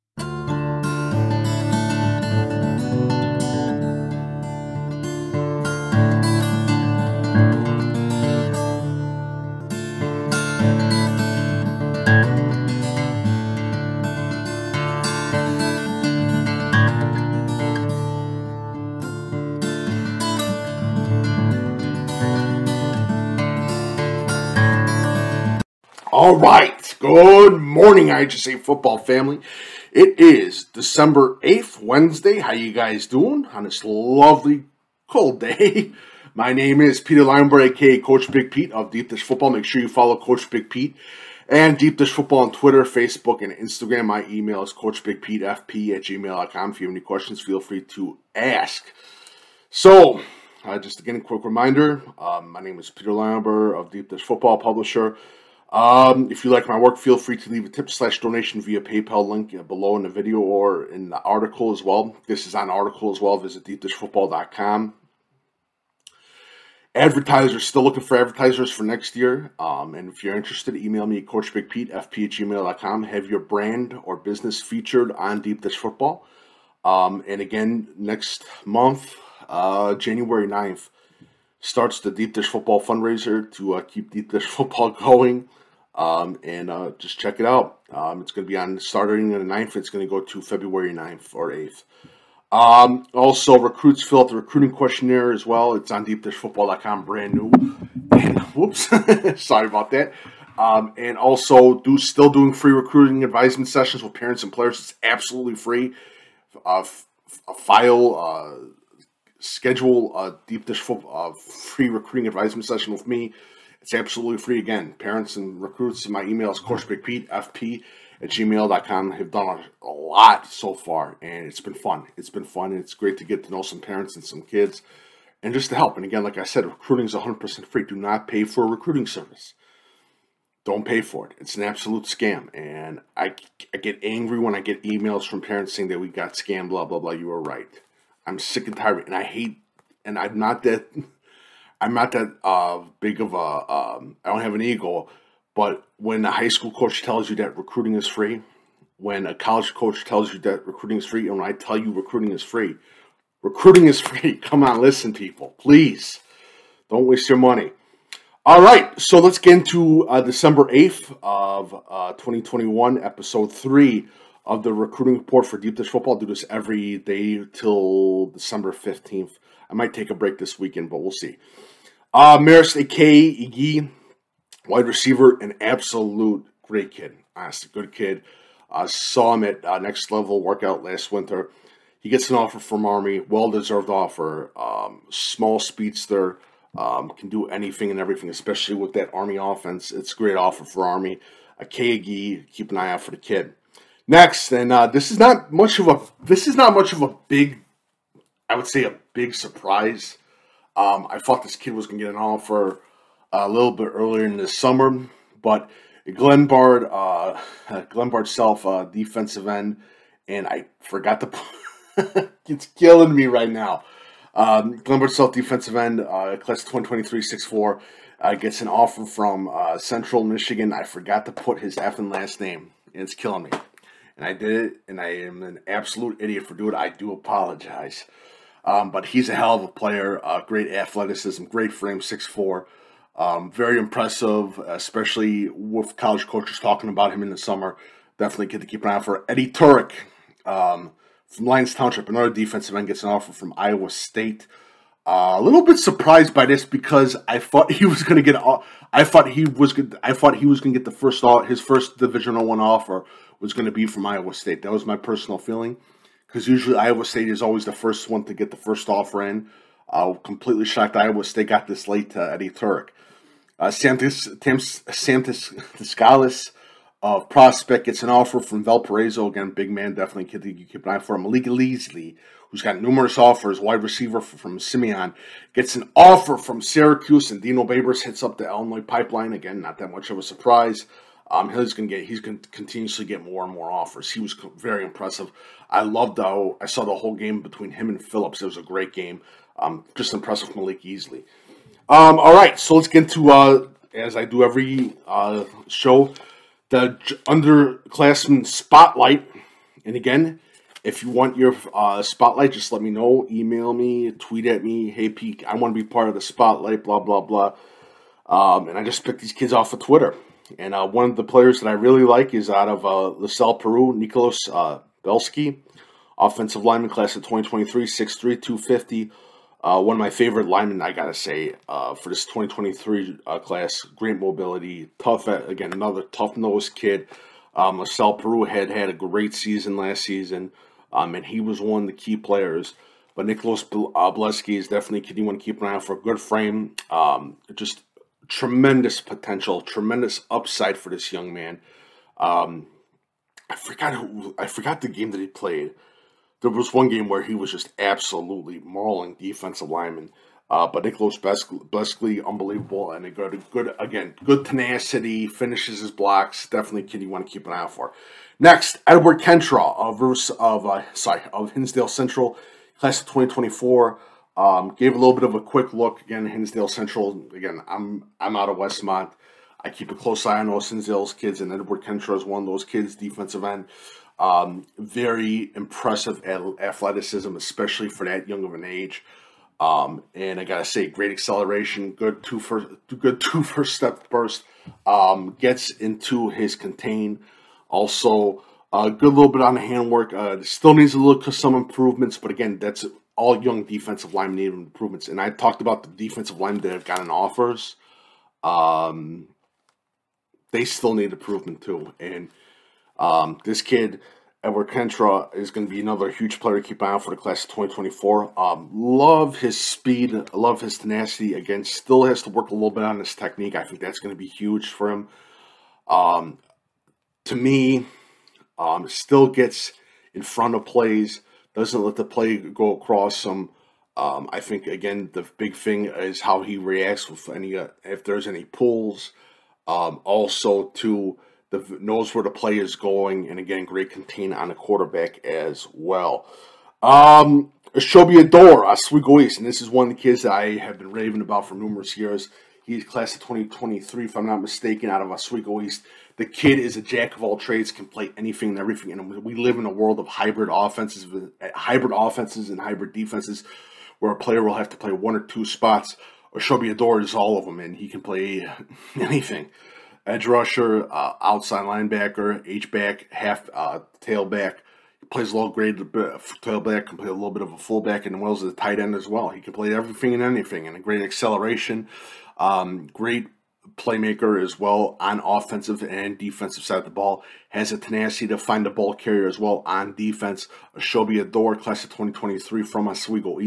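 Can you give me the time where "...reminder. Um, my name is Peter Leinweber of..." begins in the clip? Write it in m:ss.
0:51.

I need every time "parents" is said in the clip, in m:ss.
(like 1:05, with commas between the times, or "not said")
1:44, 1:54, 2:03, 2:15.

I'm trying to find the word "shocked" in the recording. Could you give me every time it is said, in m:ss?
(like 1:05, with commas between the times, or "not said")
4:20.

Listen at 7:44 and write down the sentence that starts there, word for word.
He plays little grade tailback, can play a little bit of a fullback, and Wells is a tight end as well.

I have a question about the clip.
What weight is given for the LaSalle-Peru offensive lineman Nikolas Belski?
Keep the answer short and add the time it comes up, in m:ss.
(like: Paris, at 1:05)
250, at 5:18.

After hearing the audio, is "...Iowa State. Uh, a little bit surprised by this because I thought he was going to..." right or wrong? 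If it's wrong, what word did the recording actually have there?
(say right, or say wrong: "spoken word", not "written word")
right.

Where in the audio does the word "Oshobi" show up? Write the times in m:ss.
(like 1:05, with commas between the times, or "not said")
7:36, 8:00.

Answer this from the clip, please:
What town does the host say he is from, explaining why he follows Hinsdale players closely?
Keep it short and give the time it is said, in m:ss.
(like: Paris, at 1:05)
Westmont, at 6:08.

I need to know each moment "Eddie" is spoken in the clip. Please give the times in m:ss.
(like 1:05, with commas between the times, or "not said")
3:59, 4:22.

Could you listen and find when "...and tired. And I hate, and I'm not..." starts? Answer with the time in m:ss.
2:18.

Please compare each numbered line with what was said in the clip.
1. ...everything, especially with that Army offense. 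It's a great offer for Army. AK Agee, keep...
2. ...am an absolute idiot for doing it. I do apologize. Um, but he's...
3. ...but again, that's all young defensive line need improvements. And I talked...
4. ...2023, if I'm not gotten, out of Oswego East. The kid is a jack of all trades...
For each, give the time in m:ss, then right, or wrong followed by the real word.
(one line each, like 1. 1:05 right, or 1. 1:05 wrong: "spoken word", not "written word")
1. 3:07 right
2. 3:45 right
3. 6:32 right
4. 7:23 wrong: "mistaken", not "gotten".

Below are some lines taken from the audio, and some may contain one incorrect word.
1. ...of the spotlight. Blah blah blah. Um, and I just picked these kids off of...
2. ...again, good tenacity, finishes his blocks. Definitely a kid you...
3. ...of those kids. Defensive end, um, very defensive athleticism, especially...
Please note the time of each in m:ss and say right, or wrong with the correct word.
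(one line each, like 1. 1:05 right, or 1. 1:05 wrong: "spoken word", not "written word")
1. 5:06 right
2. 5:53 right
3. 6:12 wrong: "impressive", not "defensive".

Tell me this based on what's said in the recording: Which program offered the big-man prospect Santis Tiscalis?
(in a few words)
Valparaiso.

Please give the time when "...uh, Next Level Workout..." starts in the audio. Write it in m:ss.
2:59.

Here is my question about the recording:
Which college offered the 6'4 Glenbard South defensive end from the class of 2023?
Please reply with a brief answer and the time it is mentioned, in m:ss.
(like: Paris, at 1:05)
Central Michigan, at 3:39.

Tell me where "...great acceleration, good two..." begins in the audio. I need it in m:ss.
6:20.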